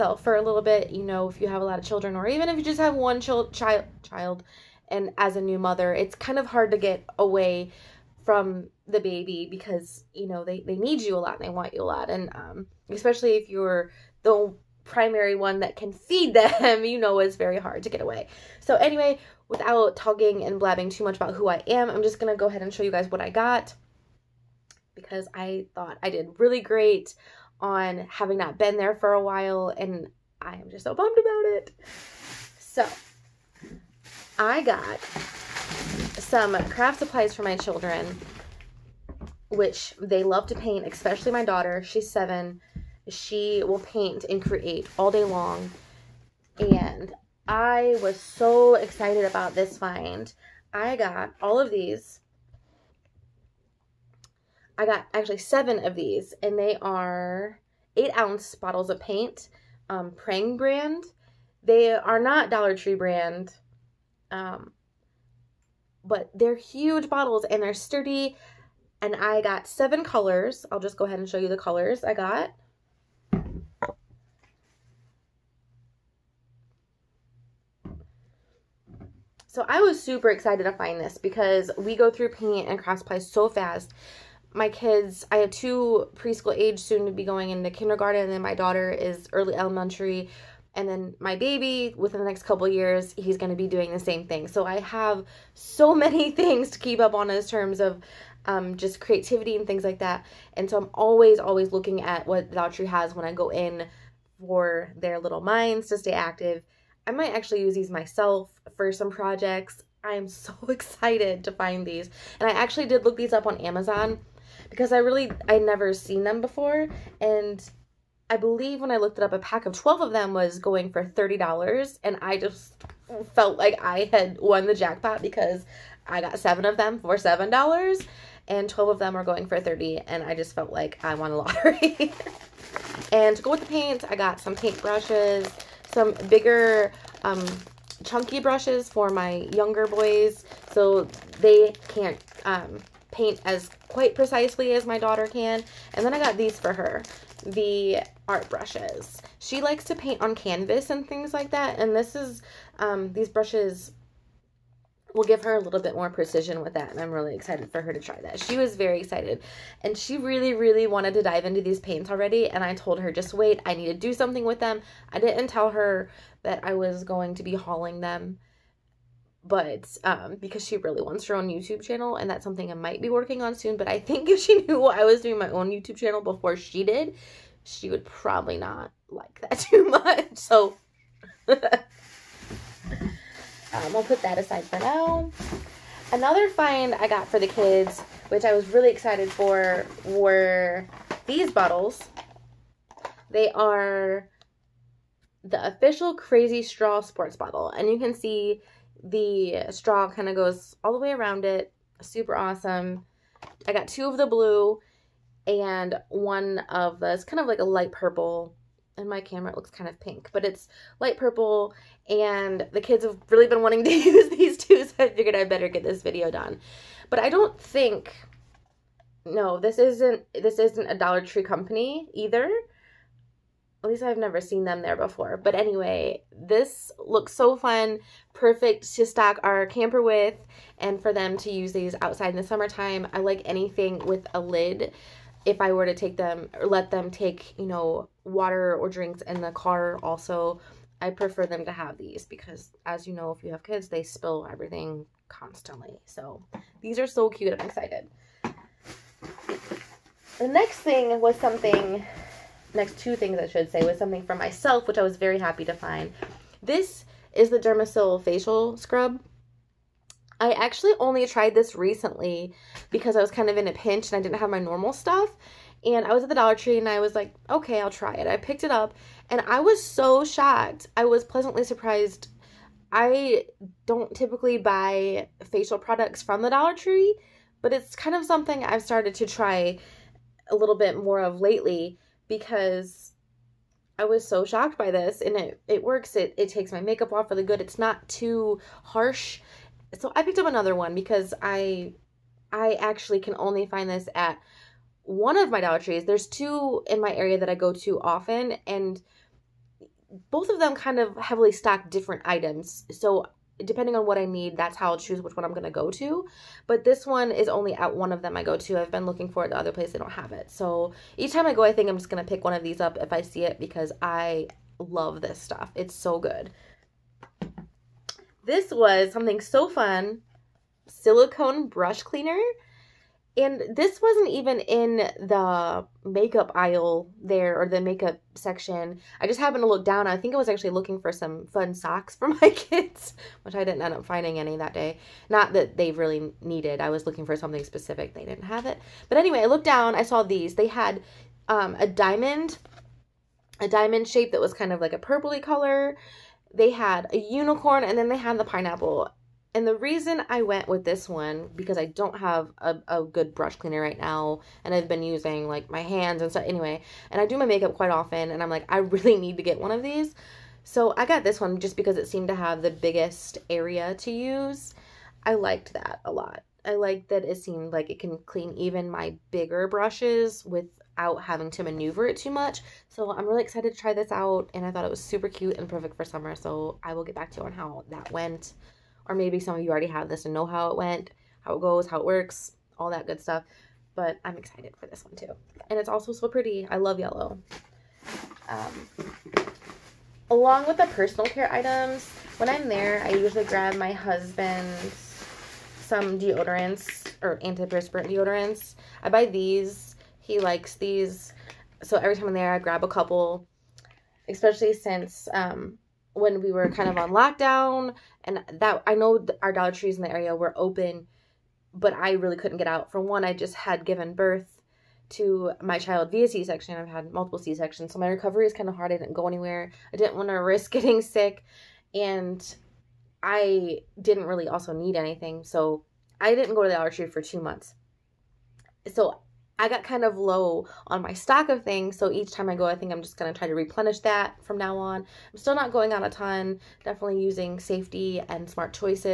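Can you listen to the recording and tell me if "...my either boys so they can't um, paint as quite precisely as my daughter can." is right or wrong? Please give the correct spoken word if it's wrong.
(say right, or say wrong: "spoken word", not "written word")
wrong: "younger", not "either".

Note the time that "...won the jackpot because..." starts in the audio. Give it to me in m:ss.
2:04.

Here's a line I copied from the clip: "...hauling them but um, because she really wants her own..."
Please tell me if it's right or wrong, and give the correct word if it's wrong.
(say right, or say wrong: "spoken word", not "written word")
right.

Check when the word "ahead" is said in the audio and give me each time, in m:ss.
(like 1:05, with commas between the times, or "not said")
0:22, 1:11.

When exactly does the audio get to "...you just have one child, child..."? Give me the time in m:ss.
0:02.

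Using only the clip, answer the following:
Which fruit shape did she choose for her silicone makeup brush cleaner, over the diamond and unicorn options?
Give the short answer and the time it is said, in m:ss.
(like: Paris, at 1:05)
pineapple, at 5:48.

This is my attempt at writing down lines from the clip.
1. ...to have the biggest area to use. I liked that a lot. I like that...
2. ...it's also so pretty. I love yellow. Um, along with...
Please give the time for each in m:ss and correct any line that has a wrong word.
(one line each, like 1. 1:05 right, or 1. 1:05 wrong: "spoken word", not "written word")
1. 6:02 right
2. 6:25 right.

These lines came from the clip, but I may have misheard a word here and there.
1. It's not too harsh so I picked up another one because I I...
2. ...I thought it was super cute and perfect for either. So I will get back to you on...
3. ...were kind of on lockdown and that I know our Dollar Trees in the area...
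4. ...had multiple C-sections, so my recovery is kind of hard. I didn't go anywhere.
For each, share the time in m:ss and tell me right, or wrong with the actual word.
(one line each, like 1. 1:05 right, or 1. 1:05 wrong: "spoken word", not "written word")
1. 4:47 right
2. 6:14 wrong: "summer", not "either"
3. 6:46 right
4. 6:56 right.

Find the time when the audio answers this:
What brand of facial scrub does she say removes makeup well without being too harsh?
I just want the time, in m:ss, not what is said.
4:17.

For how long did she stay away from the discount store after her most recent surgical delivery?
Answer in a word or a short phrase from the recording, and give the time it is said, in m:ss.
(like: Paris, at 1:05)
2 months, at 7:07.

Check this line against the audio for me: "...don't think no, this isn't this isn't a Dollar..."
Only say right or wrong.
right.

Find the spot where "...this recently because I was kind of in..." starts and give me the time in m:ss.
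4:21.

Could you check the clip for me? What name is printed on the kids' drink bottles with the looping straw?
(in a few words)
Crazy Straw.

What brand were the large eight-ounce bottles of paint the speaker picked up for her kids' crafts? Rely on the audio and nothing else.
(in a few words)
Prang.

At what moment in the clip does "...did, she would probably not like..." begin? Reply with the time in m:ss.
2:56.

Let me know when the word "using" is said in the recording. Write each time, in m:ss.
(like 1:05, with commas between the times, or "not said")
5:55, 7:17.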